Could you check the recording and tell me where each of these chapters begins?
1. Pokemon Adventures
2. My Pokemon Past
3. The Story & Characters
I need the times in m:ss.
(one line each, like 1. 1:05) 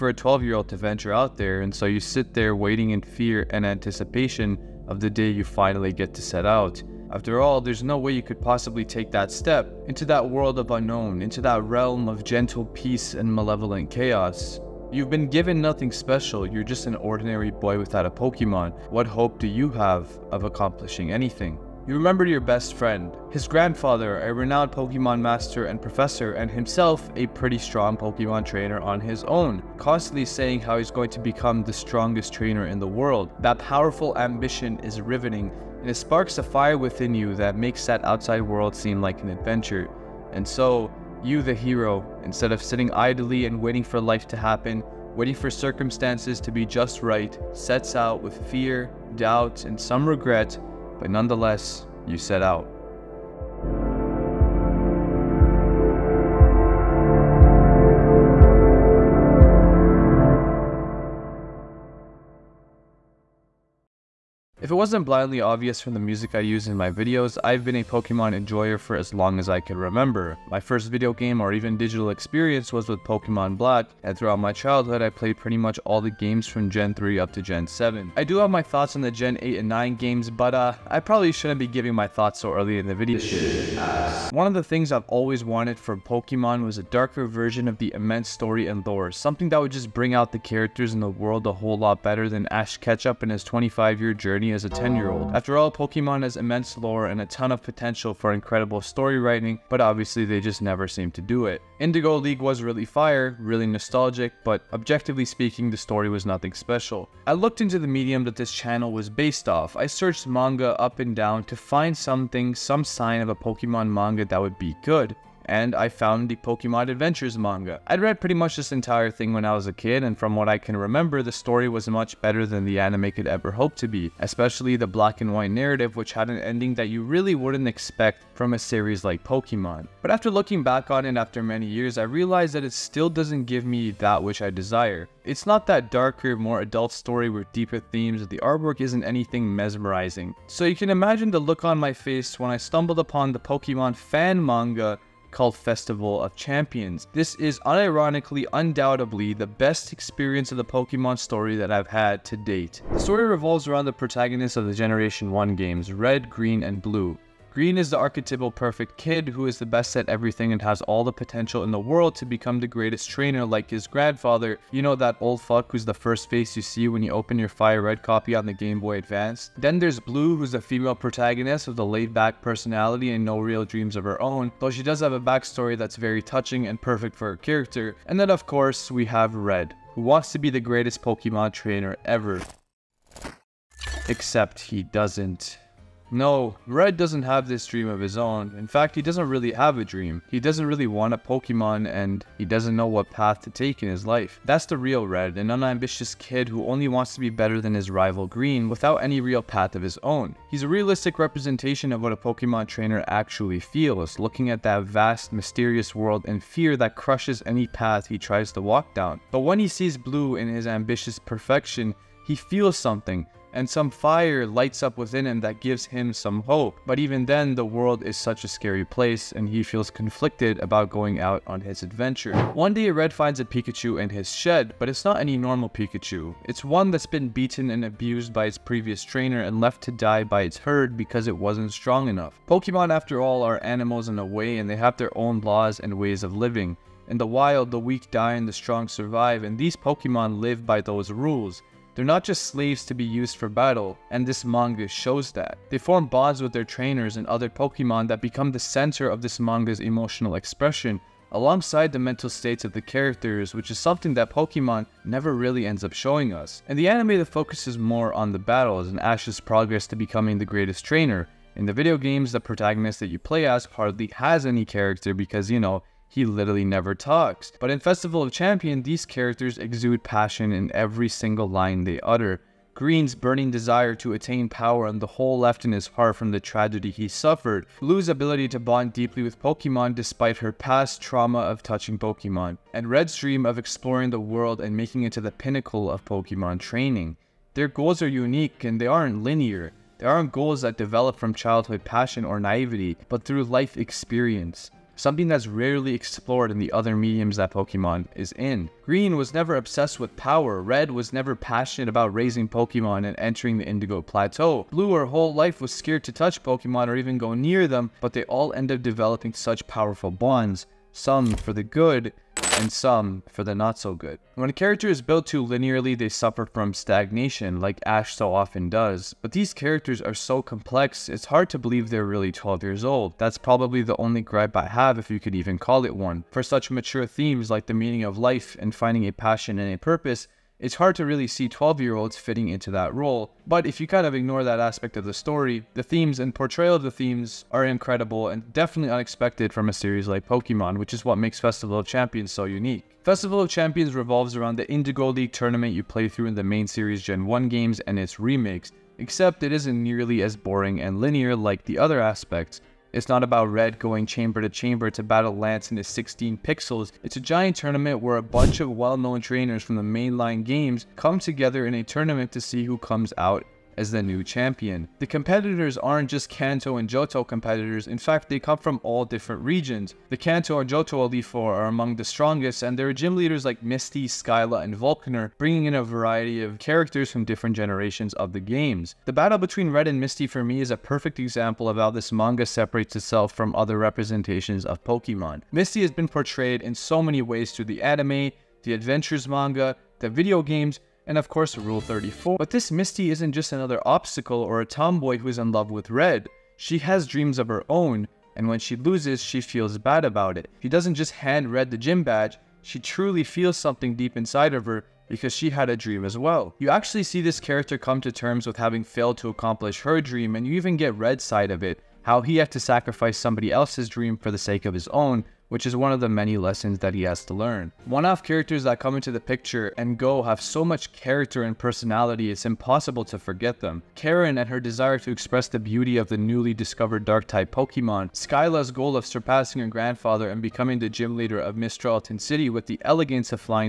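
1. 1:47
2. 1:04
3. 2:34.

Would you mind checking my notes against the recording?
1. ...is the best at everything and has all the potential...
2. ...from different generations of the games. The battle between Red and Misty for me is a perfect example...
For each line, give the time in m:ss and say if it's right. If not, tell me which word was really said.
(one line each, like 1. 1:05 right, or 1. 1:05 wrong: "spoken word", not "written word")
1. 2:39 right
2. 6:17 right.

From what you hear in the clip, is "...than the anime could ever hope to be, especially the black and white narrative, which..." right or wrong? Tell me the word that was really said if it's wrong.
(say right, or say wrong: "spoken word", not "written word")
right.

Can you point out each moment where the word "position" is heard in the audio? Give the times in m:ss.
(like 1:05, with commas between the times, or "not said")
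not said.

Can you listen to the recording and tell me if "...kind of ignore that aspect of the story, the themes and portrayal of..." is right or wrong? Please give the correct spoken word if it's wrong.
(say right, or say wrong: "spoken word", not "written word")
right.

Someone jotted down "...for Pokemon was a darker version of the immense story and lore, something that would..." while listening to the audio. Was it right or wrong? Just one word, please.
right.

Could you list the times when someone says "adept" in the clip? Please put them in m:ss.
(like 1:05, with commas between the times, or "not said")
not said.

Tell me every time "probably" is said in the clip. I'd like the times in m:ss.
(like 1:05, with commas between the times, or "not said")
1:20, 5:23.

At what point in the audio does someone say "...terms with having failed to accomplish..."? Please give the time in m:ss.
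6:48.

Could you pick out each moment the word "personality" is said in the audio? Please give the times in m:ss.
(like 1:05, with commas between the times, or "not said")
2:52, 7:01.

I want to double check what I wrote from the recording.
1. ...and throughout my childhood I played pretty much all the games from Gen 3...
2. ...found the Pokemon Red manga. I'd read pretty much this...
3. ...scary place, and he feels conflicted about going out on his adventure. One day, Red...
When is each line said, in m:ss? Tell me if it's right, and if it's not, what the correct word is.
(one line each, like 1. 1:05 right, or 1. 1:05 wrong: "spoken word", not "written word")
1. 1:14 right
2. 1:55 wrong: "Adventures", not "Red"
3. 3:38 right.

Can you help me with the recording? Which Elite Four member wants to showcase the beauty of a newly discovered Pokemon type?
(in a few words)
Karen.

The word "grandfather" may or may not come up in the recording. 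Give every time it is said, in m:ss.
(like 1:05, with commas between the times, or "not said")
0:23, 2:43, 7:09.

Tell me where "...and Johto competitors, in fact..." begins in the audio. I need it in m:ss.
6:06.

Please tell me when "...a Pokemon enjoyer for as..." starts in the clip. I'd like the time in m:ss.
1:07.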